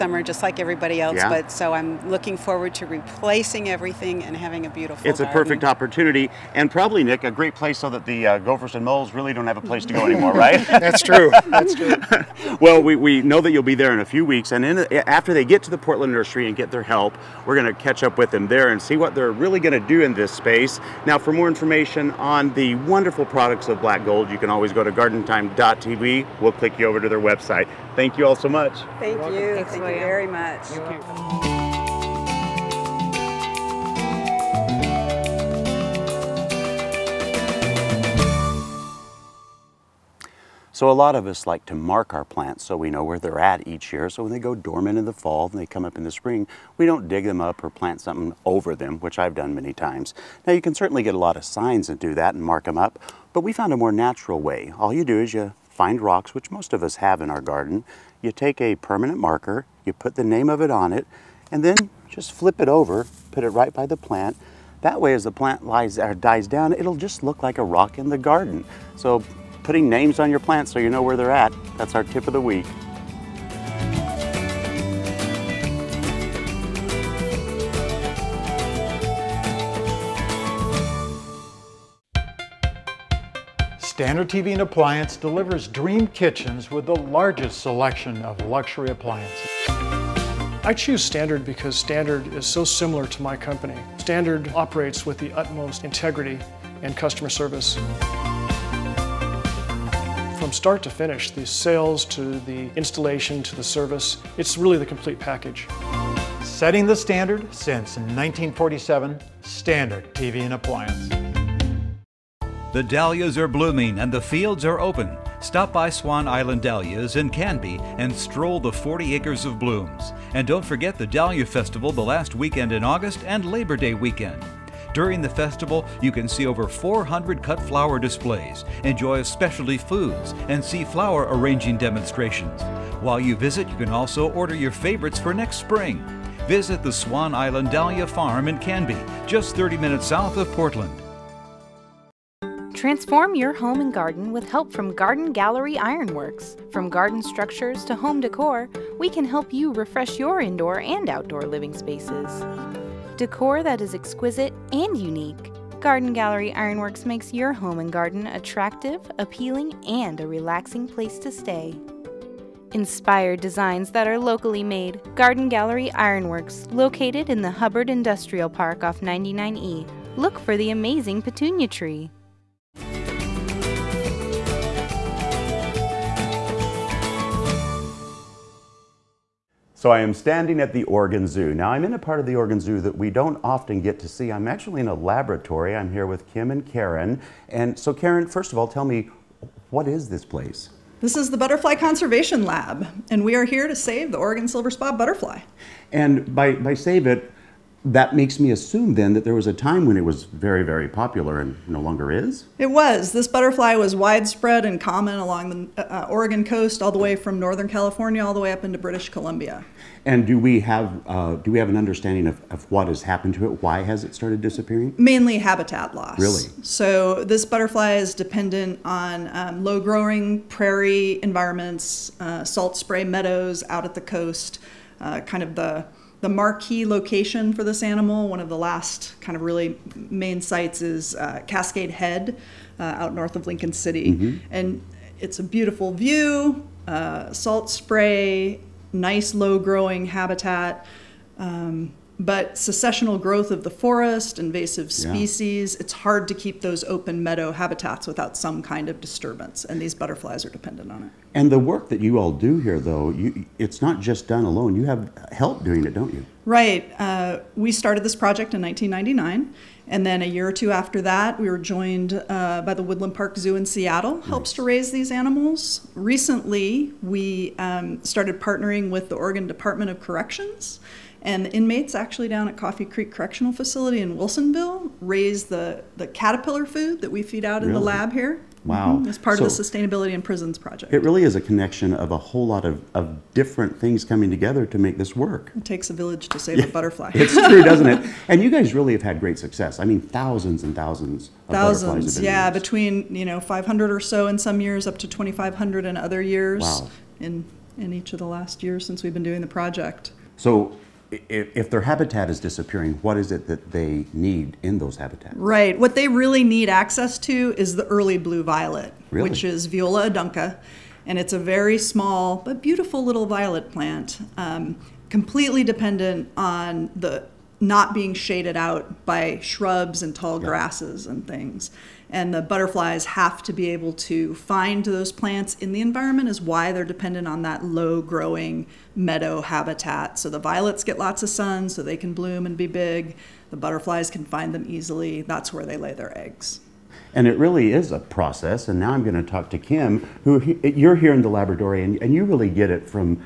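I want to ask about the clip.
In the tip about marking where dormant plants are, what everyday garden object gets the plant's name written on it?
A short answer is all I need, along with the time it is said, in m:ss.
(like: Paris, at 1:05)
Rocks, at 0:56.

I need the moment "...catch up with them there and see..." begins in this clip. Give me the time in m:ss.
0:17.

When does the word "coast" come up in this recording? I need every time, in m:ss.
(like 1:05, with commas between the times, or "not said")
3:26, 3:44.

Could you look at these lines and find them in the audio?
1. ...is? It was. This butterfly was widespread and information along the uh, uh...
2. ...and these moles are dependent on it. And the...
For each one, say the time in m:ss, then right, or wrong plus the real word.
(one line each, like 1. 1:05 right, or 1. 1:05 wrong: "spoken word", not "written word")
1. 3:22 wrong: "common", not "information"
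2. 4:09 wrong: "butterflies", not "moles".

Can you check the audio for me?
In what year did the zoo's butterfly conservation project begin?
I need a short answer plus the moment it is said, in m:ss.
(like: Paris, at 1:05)
1999, at 4:18.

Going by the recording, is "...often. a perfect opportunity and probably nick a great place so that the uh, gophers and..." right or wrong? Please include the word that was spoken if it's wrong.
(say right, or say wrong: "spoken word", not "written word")
wrong: "garden", not "often".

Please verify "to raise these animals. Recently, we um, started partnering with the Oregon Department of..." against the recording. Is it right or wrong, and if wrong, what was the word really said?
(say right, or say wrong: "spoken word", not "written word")
right.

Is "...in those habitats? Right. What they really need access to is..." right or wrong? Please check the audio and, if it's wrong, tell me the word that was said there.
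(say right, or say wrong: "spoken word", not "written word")
right.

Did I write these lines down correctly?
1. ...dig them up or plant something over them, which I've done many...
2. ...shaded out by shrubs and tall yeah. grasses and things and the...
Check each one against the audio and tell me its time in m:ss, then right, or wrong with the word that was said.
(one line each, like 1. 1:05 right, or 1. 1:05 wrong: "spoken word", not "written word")
1. 0:47 right
2. 5:18 right.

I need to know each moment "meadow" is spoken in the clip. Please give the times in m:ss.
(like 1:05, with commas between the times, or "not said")
3:43, 4:07, 5:28.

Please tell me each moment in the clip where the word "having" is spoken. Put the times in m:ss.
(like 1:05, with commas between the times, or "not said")
0:04.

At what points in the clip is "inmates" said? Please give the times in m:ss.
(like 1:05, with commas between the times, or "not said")
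4:31.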